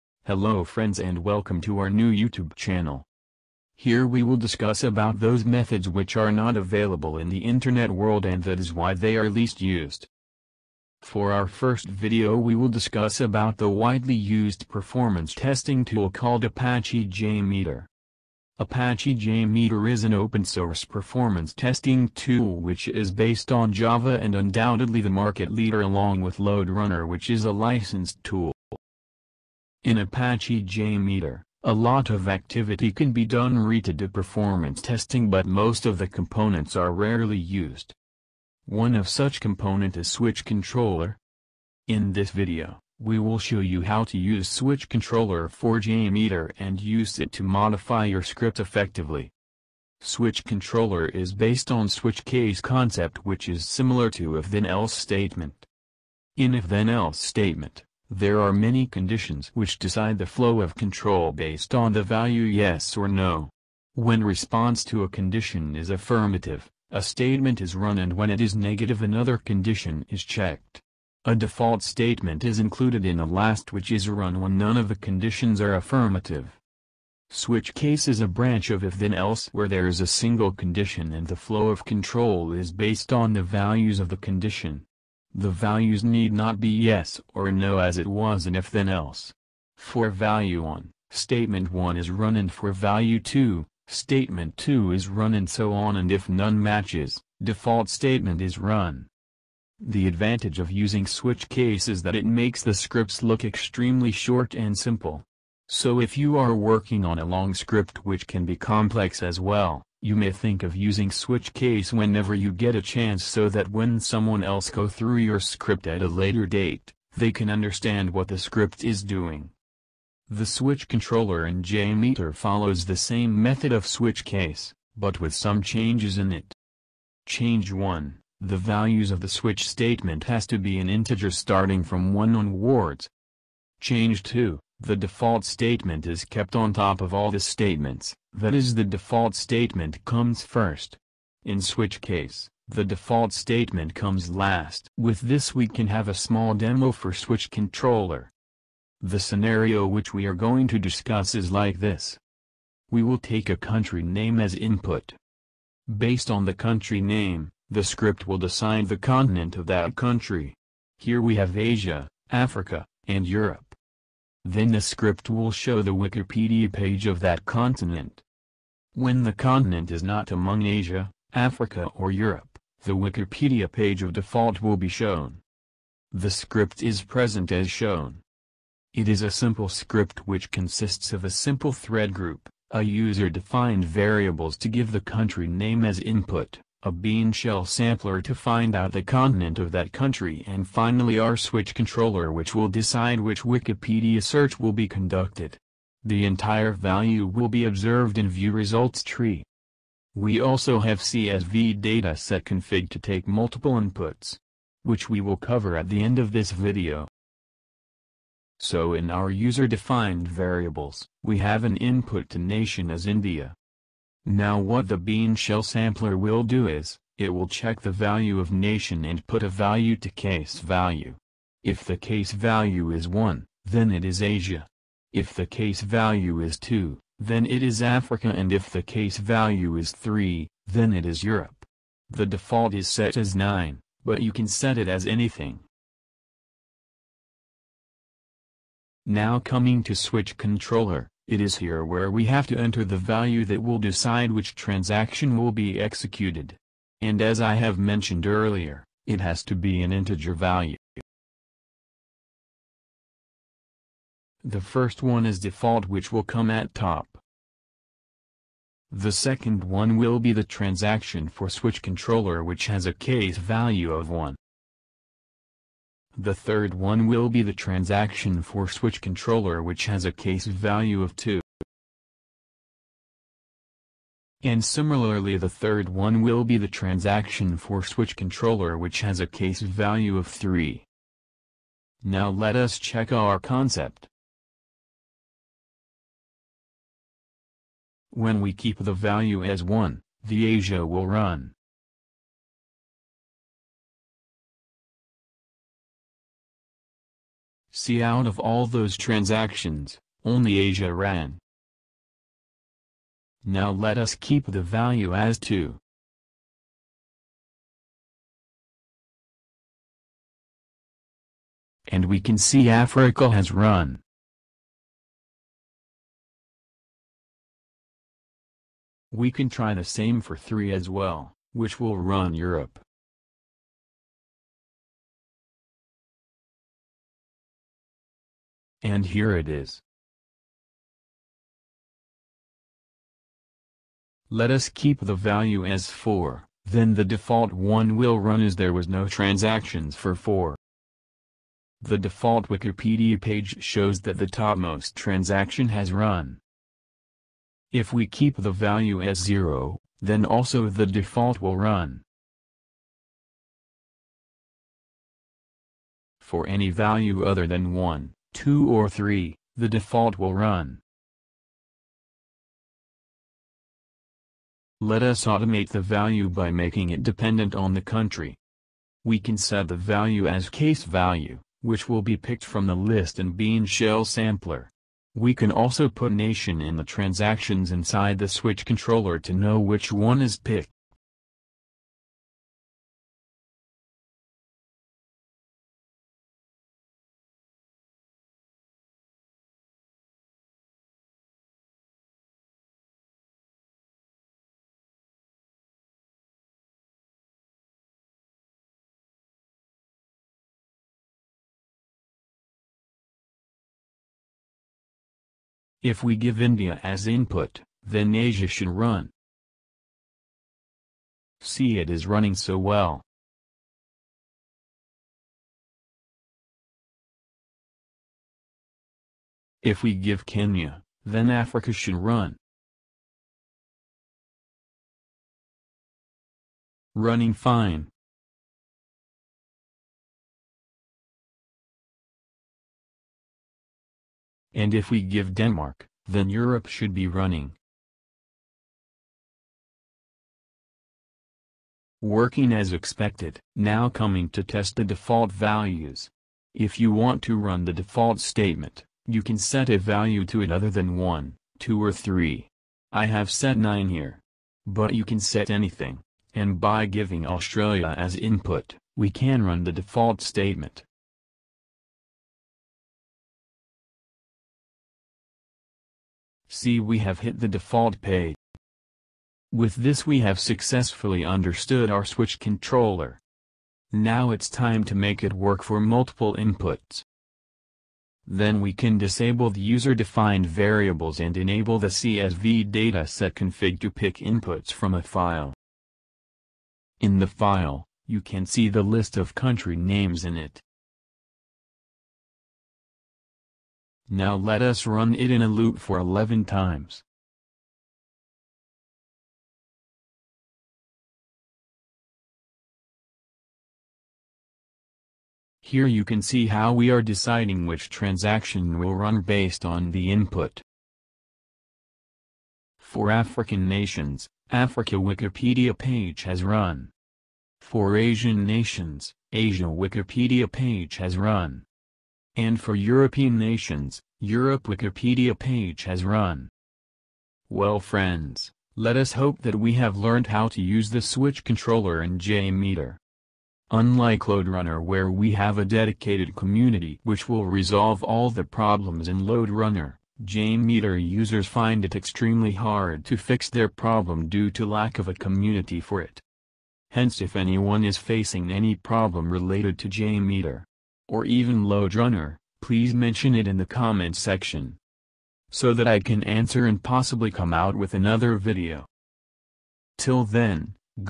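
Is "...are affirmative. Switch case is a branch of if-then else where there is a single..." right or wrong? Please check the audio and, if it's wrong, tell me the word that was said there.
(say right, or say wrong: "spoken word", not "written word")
right.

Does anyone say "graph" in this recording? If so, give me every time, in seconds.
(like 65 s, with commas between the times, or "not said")
not said.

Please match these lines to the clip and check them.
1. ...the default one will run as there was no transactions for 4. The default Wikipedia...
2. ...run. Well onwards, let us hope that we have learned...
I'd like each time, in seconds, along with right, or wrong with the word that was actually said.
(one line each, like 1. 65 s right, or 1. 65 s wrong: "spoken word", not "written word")
1. 336 s right
2. 526 s wrong: "friends", not "onwards".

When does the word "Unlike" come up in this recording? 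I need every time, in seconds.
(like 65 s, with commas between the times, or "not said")
533 s.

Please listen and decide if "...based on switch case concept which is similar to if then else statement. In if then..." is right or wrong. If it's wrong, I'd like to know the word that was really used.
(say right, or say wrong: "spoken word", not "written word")
right.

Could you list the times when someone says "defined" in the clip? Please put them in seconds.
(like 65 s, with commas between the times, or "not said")
182 s, 209 s, 479 s.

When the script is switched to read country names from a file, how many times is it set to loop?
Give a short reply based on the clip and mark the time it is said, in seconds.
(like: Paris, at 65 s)
11, at 495 s.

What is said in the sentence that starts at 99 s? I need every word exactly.
The advantage of using switch case is that it makes the scripts look extremely short and simple.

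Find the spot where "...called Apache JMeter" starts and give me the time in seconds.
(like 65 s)
16 s.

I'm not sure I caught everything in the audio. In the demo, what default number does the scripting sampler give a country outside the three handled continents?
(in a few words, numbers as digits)
9.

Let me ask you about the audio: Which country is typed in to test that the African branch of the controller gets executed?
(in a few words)
Kenya.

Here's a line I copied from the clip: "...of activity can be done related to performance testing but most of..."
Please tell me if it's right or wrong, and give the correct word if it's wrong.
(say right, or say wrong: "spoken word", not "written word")
right.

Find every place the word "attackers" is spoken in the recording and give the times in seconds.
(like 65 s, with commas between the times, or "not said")
not said.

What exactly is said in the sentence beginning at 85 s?
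The values need not be yes or no as it was in if then else.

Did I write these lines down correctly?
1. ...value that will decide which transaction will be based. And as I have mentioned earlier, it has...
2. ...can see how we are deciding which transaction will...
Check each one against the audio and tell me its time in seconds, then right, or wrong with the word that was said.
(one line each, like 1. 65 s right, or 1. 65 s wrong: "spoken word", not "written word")
1. 242 s wrong: "executed", not "based"
2. 506 s right.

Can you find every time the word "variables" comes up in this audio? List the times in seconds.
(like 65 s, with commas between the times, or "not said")
183 s, 210 s, 480 s.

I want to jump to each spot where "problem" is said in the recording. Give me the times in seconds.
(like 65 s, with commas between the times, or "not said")
538 s, 543 s, 548 s.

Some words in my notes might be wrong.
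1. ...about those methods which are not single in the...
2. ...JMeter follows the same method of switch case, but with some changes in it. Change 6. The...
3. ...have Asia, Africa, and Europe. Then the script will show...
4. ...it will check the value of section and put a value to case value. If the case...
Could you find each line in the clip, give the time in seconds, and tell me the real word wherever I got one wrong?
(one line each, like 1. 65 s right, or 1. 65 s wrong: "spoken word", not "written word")
1. 4 s wrong: "available", not "single"
2. 121 s wrong: "1", not "6"
3. 161 s right
4. 217 s wrong: "nation", not "section".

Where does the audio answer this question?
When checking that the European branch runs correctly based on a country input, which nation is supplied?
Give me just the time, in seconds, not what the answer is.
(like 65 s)
435 s.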